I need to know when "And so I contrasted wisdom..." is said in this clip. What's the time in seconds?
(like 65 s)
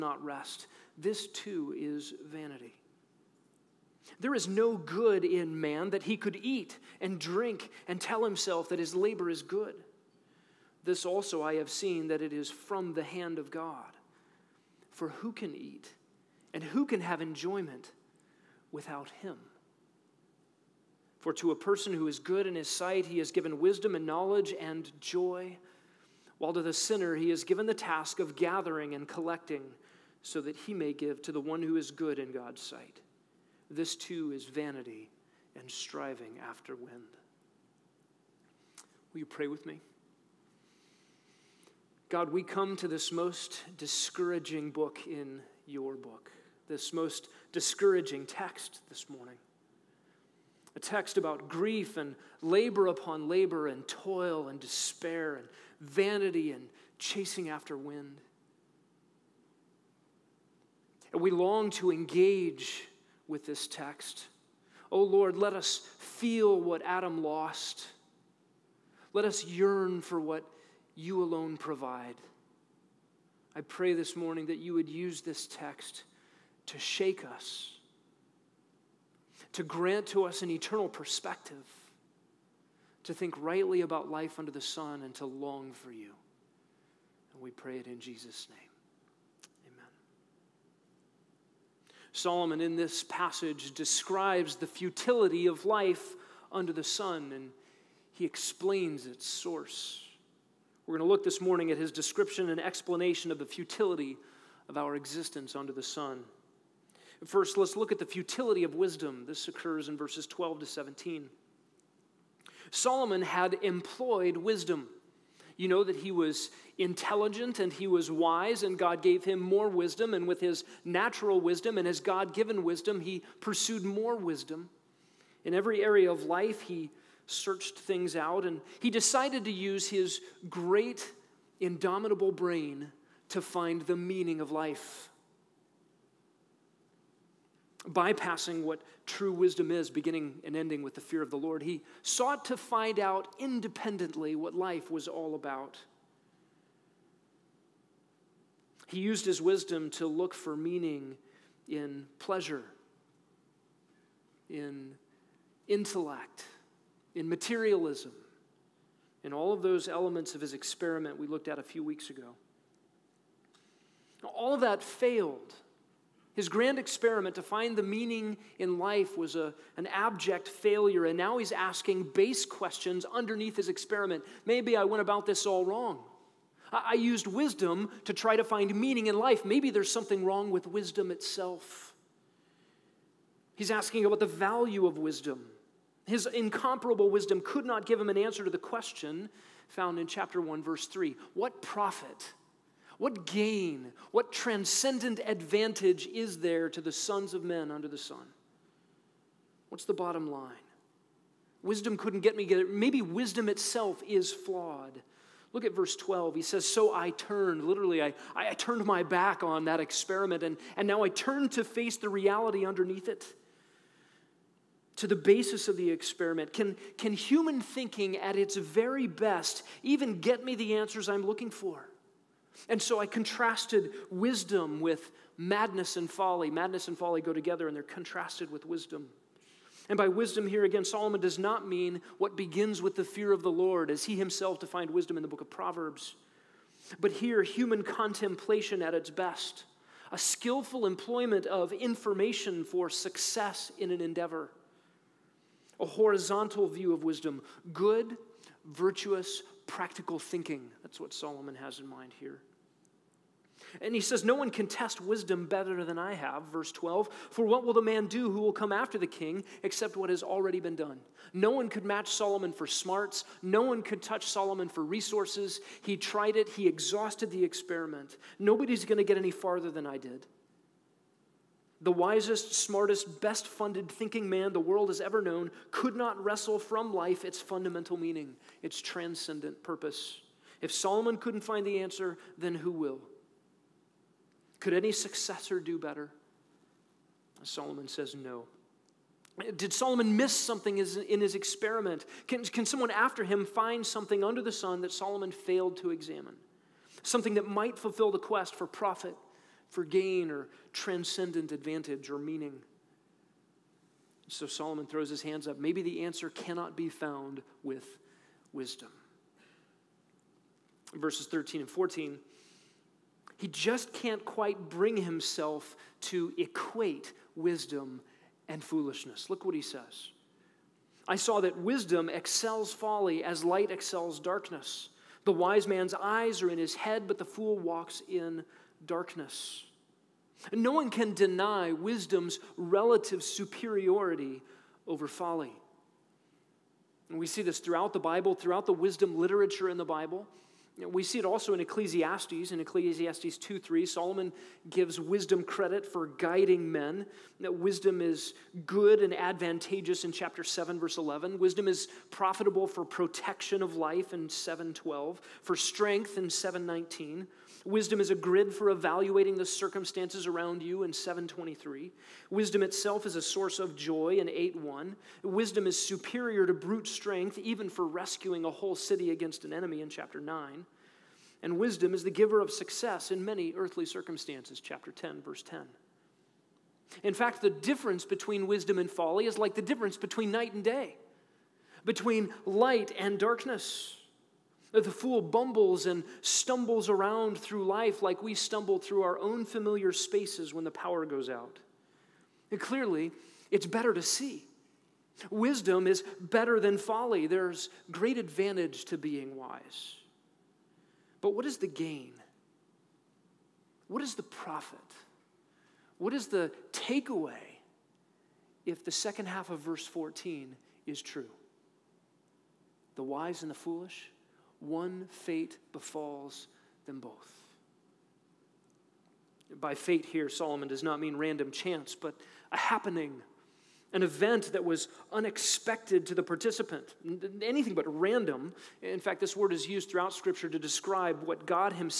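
222 s.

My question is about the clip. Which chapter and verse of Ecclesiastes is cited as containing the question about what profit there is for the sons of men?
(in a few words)
chapter 1, verse 3.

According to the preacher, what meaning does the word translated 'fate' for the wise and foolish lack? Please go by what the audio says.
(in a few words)
random chance.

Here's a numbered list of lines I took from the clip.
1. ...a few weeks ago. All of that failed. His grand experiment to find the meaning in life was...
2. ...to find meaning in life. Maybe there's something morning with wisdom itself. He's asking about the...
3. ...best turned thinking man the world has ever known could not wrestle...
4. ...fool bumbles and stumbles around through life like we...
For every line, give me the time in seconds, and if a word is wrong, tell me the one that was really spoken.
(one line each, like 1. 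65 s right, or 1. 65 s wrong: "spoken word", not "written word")
1. 161 s right
2. 178 s wrong: "wrong", not "morning"
3. 273 s wrong: "funded", not "turned"
4. 384 s right.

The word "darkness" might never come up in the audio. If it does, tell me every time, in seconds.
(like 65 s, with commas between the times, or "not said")
324 s, 328 s, 383 s.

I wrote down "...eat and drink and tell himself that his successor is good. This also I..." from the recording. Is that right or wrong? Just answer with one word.
wrong.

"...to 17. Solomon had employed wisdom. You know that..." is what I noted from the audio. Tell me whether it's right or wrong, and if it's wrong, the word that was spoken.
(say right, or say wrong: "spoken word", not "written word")
right.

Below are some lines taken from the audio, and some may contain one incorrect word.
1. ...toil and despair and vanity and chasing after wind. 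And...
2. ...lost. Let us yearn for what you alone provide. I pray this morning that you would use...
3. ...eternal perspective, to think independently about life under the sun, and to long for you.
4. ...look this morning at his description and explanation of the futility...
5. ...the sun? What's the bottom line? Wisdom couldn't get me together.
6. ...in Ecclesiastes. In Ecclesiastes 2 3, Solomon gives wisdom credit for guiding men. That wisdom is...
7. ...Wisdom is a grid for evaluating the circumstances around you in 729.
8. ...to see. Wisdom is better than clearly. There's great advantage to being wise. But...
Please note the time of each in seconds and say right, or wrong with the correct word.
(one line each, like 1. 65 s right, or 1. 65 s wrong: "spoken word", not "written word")
1. 53 s right
2. 67 s right
3. 80 s wrong: "rightly", not "independently"
4. 101 s right
5. 197 s right
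6. 341 s right
7. 357 s wrong: "723", not "729"
8. 393 s wrong: "folly", not "clearly".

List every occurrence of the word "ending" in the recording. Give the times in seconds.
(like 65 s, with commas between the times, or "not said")
140 s.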